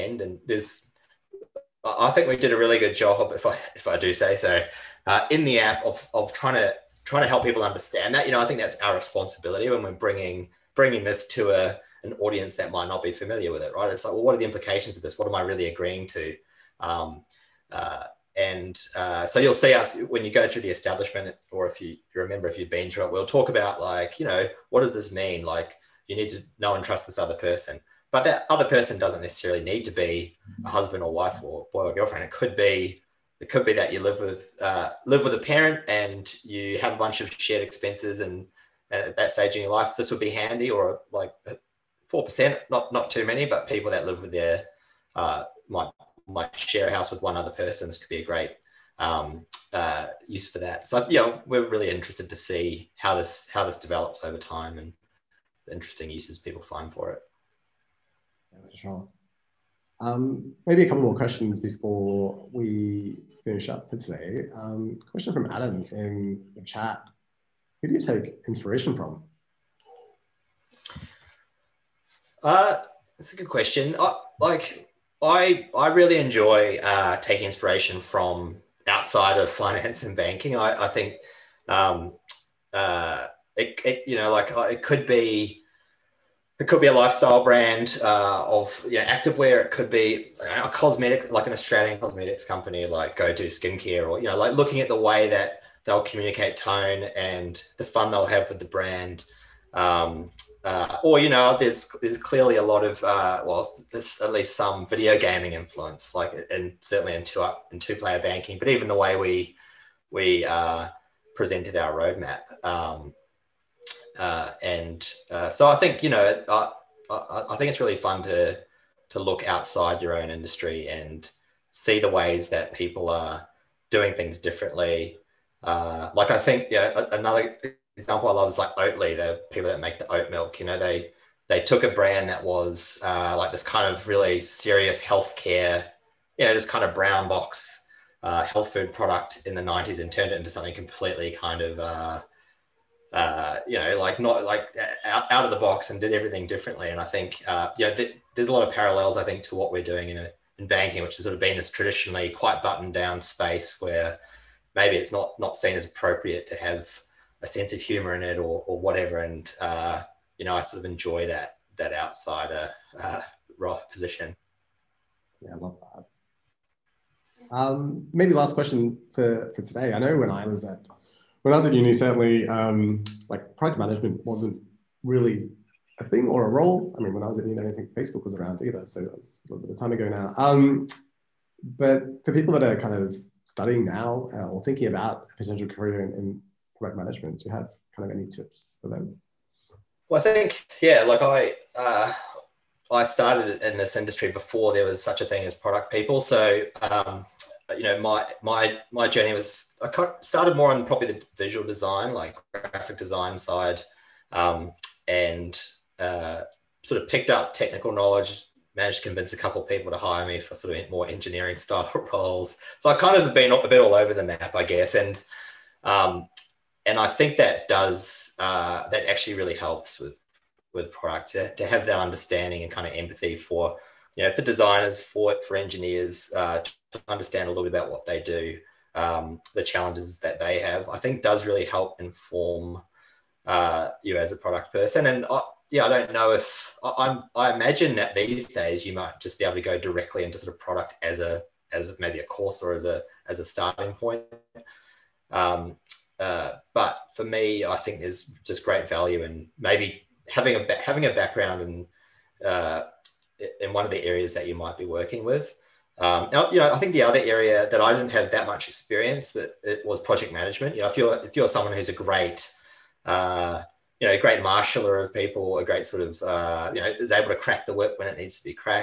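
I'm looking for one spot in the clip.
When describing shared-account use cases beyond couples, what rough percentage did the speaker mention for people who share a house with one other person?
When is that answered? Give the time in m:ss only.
0:42.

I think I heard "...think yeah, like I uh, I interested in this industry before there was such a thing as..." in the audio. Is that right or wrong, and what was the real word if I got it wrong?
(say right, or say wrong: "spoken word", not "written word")
wrong: "started", not "interested".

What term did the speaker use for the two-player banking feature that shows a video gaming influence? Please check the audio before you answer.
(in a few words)
2Up.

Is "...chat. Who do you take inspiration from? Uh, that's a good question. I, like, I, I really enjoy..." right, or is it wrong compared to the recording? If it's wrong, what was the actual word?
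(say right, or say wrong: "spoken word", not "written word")
right.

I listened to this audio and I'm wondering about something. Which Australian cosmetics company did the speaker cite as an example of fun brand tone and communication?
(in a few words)
Go-To Skincare.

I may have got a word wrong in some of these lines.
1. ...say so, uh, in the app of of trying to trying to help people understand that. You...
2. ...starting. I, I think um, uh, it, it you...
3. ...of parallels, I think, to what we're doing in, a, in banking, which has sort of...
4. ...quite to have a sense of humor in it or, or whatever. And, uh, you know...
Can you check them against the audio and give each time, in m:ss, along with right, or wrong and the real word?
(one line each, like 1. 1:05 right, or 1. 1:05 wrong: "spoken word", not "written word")
1. 0:04 right
2. 1:20 wrong: "banking", not "starting"
3. 2:28 right
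4. 2:35 wrong: "appropriate", not "quite".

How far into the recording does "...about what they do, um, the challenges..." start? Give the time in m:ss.
3:47.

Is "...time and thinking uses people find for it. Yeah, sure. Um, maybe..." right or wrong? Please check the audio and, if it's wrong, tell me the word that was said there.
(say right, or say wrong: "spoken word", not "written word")
wrong: "interesting", not "thinking".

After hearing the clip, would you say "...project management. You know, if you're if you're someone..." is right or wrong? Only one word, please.
right.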